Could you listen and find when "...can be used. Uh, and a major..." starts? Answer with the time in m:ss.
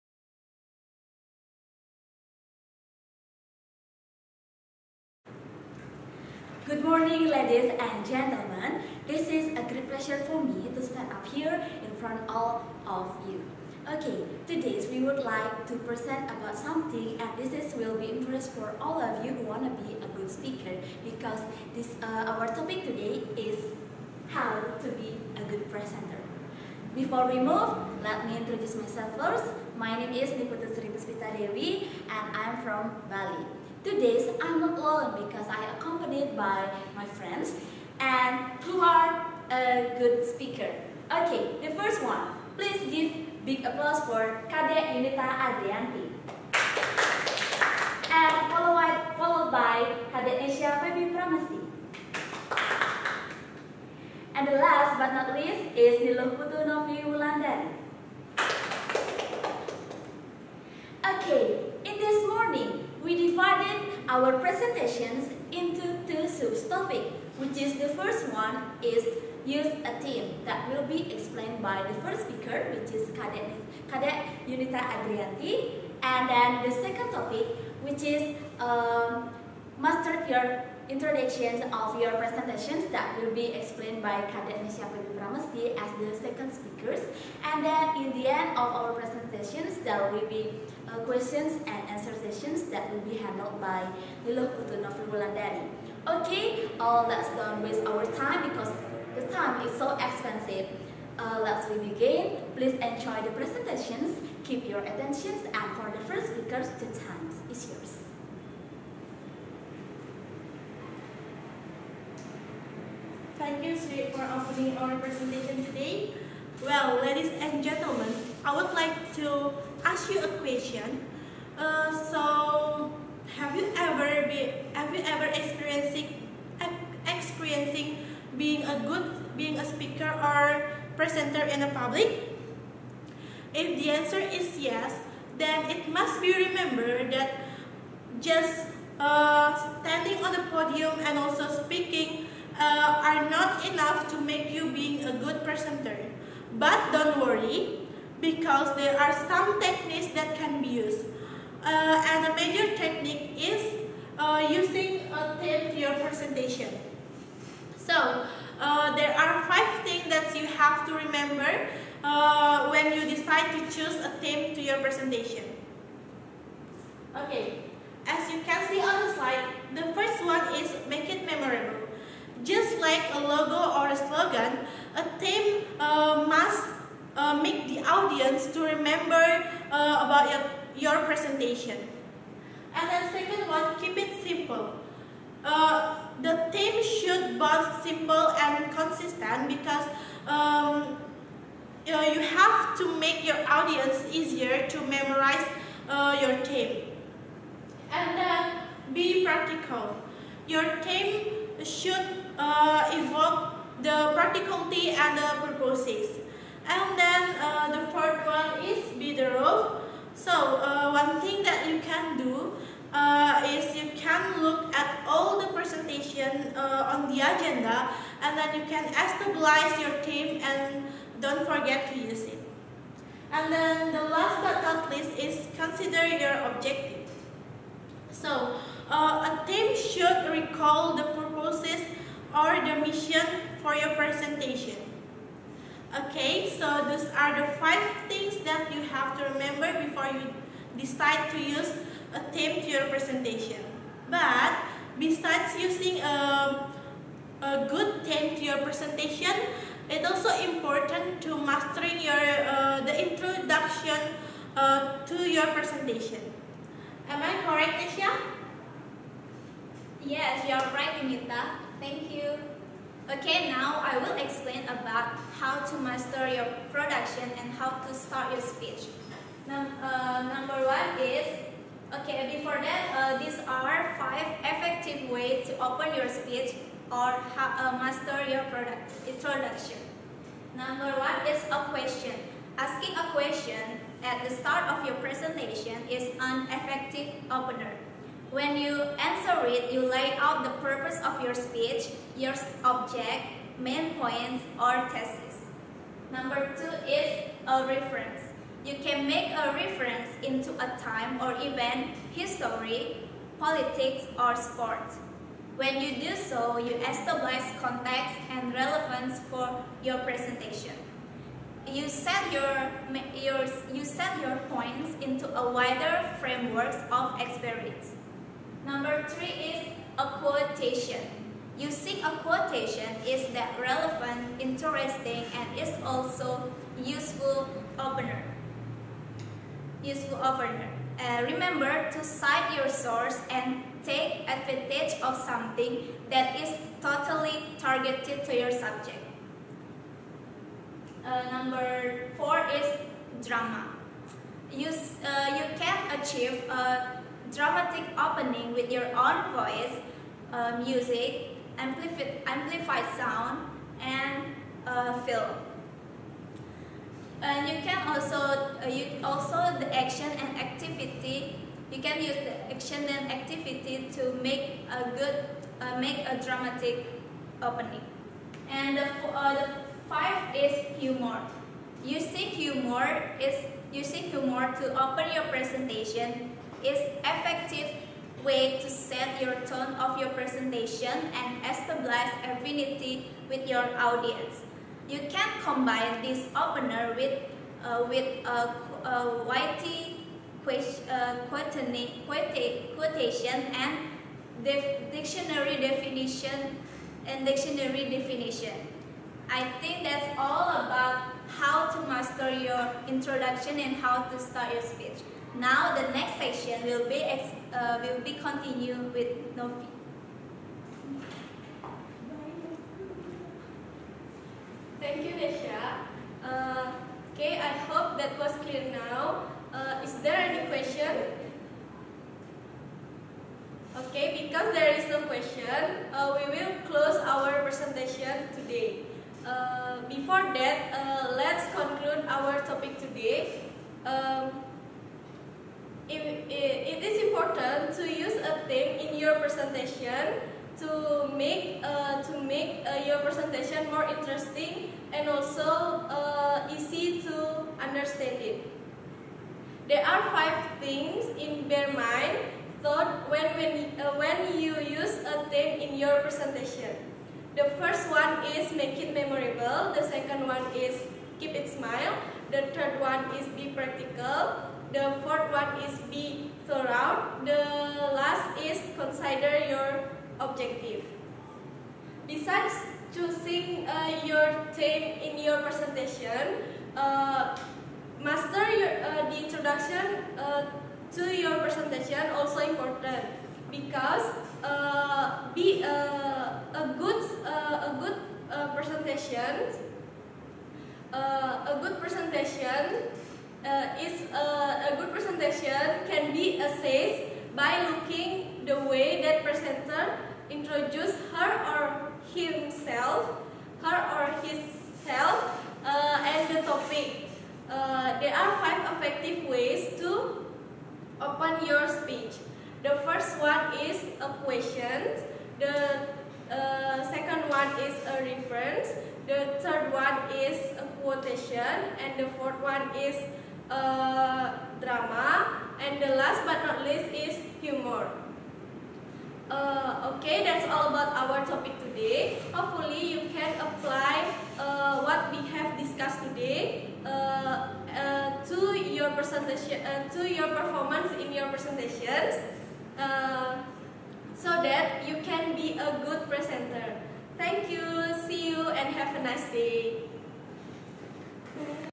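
2:30.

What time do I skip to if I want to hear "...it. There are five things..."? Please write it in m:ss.
7:28.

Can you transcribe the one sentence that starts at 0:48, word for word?
And followed, followed by Kade Asia Feby Pramesti.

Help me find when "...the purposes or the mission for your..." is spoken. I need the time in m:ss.
3:50.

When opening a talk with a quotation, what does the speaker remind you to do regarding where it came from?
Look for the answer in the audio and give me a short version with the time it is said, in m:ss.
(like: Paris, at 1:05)
Cite your source, at 5:32.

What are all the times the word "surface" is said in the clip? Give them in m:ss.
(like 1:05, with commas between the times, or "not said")
not said.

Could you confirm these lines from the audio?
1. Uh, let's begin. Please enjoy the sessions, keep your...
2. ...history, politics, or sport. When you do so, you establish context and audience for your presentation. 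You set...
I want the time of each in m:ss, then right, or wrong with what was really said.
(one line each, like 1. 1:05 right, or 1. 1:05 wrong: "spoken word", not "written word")
1. 1:41 wrong: "presentations", not "sessions"
2. 5:02 wrong: "relevance", not "audience".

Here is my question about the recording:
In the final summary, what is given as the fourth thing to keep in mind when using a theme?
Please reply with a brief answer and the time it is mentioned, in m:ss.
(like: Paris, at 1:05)
Be thorough, at 7:45.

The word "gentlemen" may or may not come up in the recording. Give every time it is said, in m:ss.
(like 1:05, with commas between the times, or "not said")
0:08, 1:57.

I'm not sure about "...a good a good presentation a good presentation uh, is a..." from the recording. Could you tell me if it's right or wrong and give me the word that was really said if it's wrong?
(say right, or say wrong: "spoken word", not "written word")
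right.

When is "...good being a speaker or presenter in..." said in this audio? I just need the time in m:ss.
2:08.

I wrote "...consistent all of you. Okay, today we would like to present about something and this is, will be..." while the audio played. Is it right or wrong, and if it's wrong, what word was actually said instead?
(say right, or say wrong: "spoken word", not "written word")
wrong: "front", not "consistent".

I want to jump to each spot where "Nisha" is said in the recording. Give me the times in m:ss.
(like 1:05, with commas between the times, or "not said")
4:17, 6:55.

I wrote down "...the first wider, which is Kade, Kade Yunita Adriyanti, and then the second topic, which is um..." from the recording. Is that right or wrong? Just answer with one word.
wrong.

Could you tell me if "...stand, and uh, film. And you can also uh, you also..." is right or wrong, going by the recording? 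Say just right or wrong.
wrong.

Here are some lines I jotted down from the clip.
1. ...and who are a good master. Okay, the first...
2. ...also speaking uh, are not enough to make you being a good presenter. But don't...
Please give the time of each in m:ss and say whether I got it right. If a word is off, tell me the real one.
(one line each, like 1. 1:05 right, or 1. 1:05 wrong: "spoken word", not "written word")
1. 0:37 wrong: "speaker", not "master"
2. 2:21 right.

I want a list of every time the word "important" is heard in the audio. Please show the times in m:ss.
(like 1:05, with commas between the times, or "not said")
4:10, 7:17, 8:02.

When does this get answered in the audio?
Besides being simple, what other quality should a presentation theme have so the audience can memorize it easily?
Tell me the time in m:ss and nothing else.
3:08.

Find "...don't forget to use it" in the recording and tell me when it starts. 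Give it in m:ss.
3:41.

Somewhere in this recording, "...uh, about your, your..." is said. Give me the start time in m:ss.
2:59.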